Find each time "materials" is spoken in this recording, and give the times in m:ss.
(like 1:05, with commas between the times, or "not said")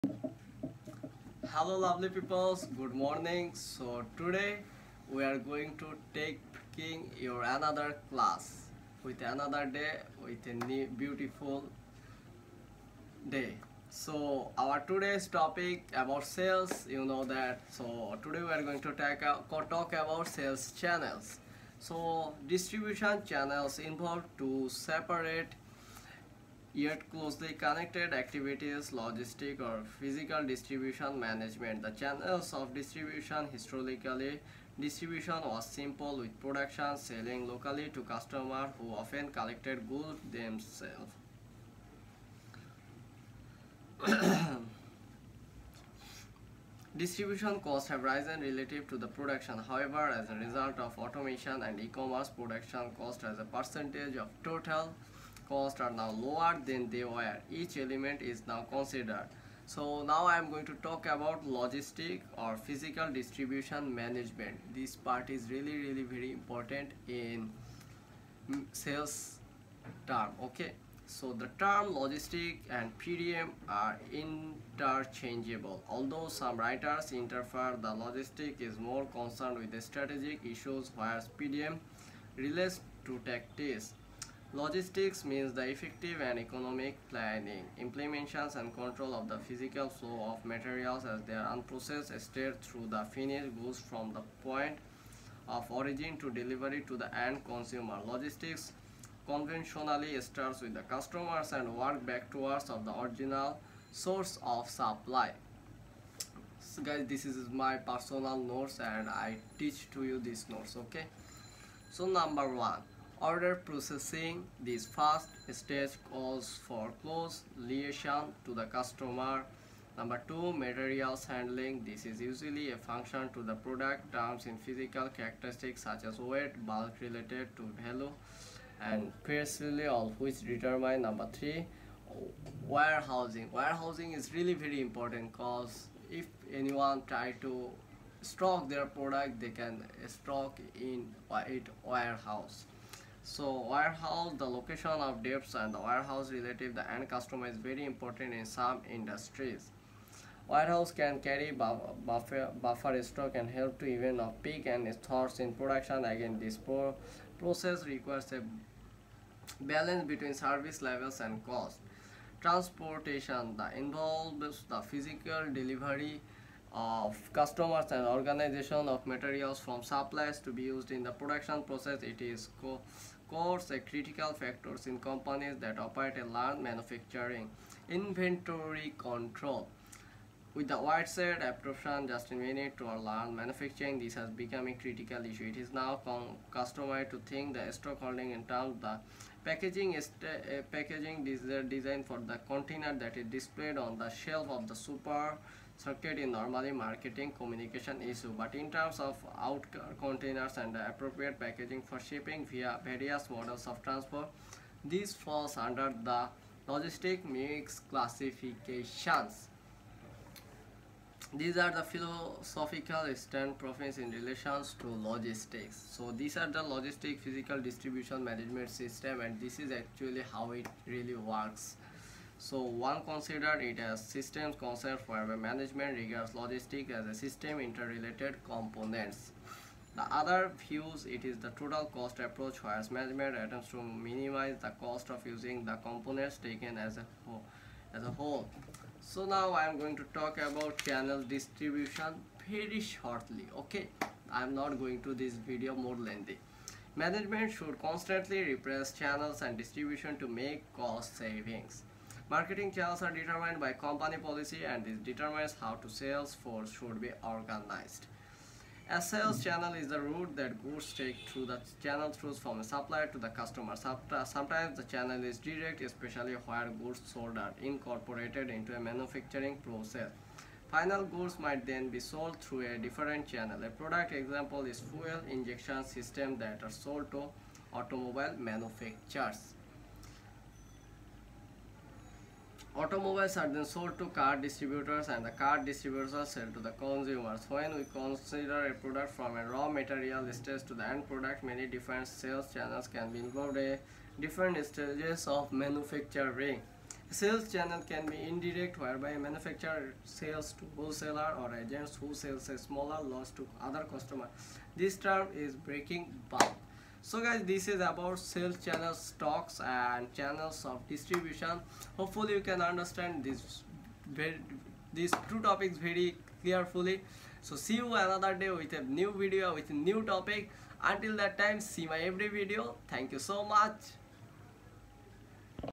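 1:30, 2:00, 2:49, 4:49.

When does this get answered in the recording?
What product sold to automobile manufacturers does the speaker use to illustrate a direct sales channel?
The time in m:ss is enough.
4:34.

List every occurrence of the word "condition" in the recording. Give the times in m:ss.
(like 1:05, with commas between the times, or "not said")
not said.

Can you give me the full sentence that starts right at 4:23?
Sometimes the channel is direct, especially where goods sold are incorporated into a manufacturing process.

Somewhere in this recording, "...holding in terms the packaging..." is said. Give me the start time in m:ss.
3:08.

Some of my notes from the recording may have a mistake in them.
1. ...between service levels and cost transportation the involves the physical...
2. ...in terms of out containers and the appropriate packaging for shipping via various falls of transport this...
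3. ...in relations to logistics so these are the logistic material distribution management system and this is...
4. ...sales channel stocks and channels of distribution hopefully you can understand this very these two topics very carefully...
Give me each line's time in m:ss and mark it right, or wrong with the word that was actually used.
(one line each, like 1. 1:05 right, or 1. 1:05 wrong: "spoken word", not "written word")
1. 2:40 right
2. 3:18 wrong: "models", not "falls"
3. 3:33 wrong: "physical", not "material"
4. 5:08 right.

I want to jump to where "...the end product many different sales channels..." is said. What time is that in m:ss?
4:50.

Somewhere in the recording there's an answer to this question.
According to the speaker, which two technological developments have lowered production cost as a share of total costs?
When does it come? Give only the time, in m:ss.
0:50.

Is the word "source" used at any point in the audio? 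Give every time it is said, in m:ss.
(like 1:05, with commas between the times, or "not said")
1:43.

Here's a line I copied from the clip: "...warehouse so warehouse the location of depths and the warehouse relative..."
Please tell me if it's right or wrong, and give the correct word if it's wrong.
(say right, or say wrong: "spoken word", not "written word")
right.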